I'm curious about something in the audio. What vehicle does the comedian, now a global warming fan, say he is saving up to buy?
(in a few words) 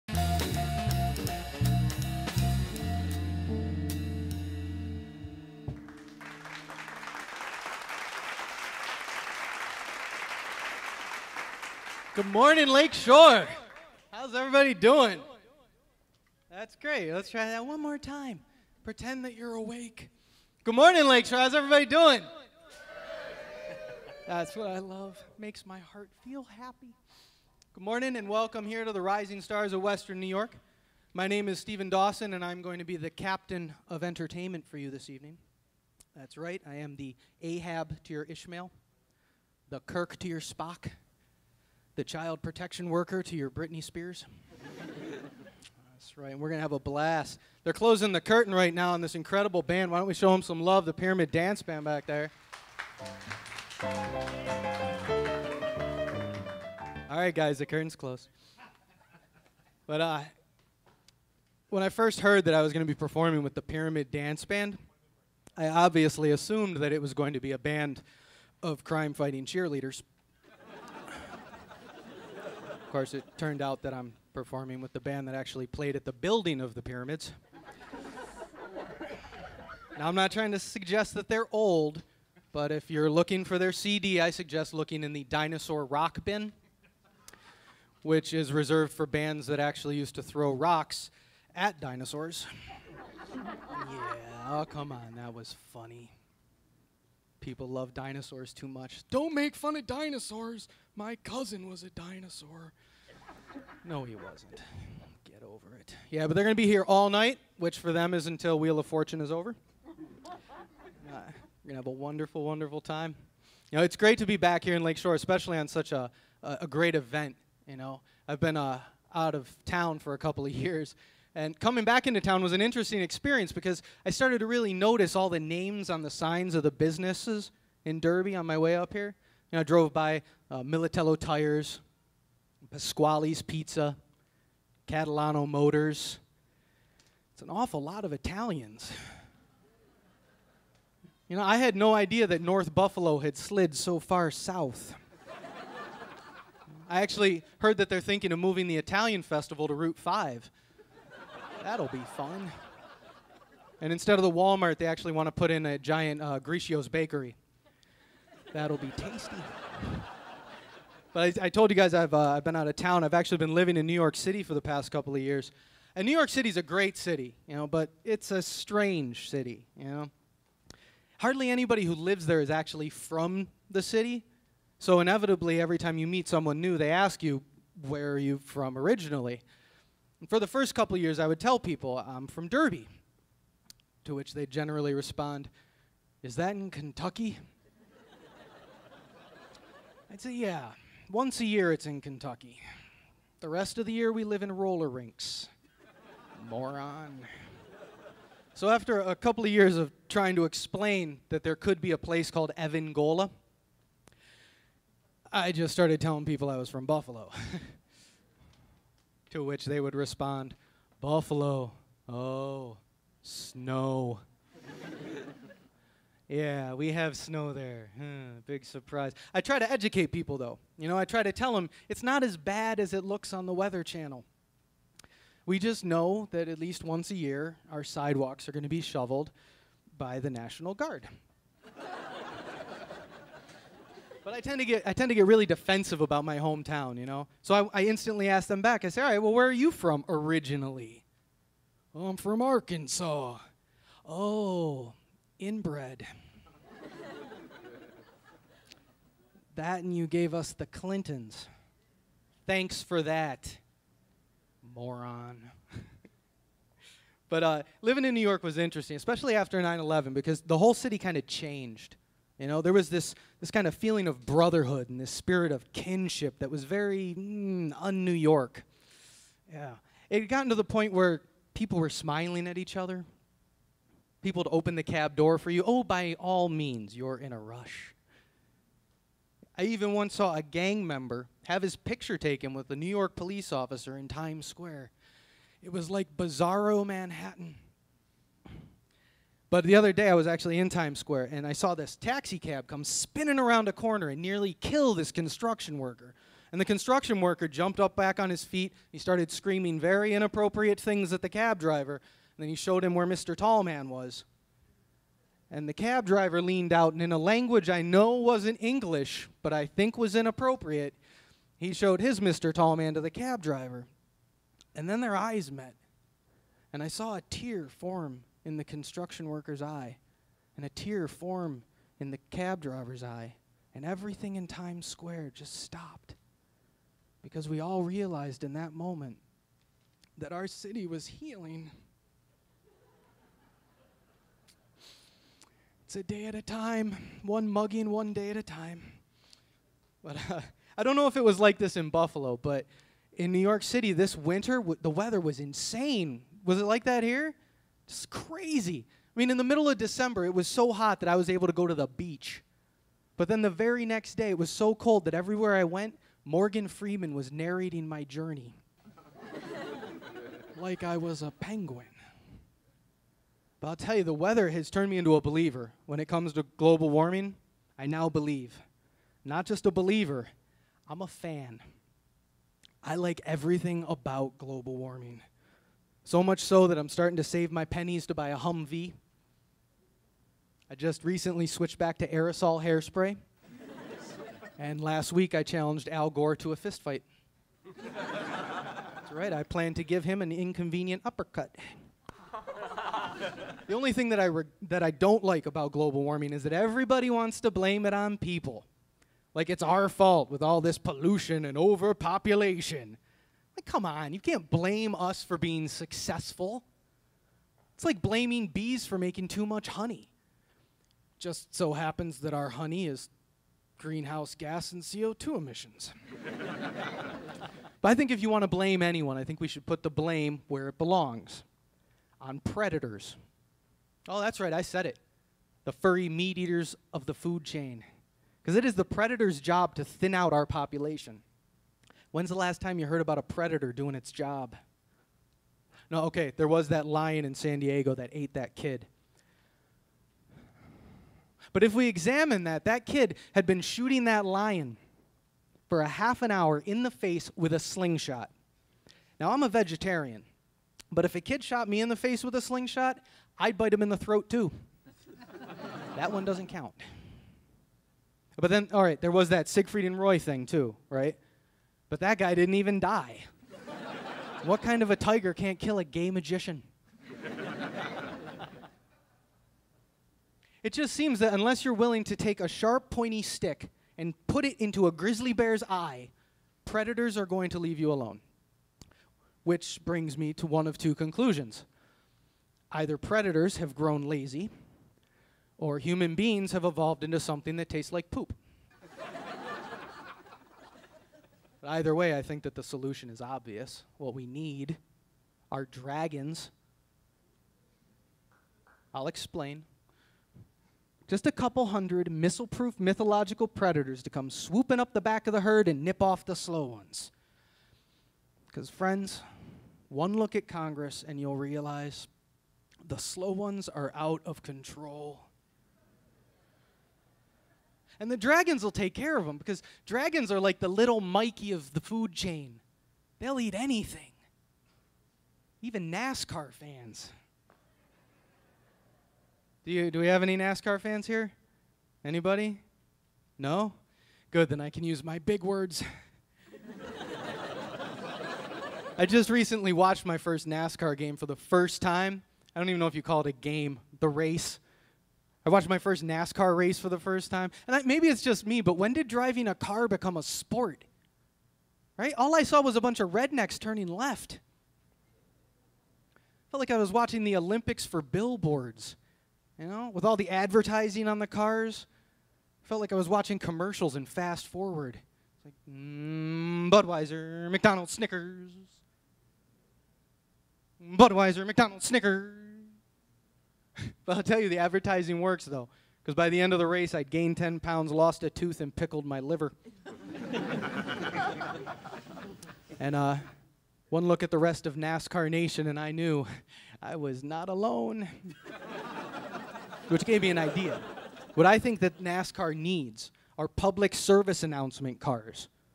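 Humvee.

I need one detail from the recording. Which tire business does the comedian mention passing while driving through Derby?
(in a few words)
Militello Tires.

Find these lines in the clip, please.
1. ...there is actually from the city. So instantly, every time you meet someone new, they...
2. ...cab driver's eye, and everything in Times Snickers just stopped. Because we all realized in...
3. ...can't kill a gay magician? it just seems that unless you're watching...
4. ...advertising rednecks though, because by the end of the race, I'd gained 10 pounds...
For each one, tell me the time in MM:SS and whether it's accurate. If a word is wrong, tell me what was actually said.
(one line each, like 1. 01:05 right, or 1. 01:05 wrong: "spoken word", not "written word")
1. 02:52 wrong: "inevitably", not "instantly"
2. 05:22 wrong: "Square", not "Snickers"
3. 07:45 wrong: "willing", not "watching"
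4. 09:34 wrong: "works", not "rednecks".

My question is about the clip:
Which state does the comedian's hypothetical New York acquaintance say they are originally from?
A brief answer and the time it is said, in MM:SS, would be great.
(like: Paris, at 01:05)
Arkansas, at 04:02.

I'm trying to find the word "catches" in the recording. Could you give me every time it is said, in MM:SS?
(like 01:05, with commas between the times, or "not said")
not said.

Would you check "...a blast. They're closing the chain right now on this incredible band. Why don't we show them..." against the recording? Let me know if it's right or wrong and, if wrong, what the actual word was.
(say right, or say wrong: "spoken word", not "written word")
wrong: "curtain", not "chain".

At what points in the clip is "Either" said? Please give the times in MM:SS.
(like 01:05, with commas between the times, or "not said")
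08:02, 08:11.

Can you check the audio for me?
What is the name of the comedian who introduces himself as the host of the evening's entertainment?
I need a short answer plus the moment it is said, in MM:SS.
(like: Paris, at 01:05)
Stephen Dawson, at 00:31.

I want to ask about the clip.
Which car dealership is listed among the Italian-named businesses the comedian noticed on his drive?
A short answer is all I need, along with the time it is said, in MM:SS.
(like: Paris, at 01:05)
Catalano Motors, at 02:14.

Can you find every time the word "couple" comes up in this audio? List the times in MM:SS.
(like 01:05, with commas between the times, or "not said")
02:00, 02:44, 03:00, 03:19, 08:21.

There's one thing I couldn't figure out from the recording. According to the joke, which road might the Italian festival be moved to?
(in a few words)
Route 5.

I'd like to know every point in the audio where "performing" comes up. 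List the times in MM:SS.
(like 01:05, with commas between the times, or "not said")
01:02, 01:14.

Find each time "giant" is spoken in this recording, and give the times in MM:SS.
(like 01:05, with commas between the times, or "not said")
02:35.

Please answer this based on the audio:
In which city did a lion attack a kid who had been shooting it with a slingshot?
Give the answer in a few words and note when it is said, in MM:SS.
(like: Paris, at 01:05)
San Diego, at 07:17.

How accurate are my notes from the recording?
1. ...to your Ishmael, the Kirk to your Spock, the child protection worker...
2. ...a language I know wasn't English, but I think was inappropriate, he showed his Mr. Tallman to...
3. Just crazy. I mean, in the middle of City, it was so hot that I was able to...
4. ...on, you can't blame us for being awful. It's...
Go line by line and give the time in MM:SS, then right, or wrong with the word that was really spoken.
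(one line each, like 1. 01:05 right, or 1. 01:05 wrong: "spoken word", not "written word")
1. 00:38 right
2. 05:07 right
3. 05:47 wrong: "December", not "City"
4. 06:43 wrong: "successful", not "awful".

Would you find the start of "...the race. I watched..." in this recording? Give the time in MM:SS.
09:03.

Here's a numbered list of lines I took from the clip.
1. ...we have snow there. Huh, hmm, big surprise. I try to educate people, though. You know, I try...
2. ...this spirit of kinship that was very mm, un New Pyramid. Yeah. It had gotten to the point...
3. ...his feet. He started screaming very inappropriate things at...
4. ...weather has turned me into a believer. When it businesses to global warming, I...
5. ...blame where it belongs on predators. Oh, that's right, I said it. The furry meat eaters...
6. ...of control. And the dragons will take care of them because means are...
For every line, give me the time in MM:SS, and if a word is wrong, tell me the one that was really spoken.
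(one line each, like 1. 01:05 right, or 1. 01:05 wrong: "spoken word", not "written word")
1. 03:36 right
2. 04:24 wrong: "York", not "Pyramid"
3. 04:58 right
4. 06:04 wrong: "comes", not "businesses"
5. 06:59 right
6. 08:34 wrong: "dragons", not "means".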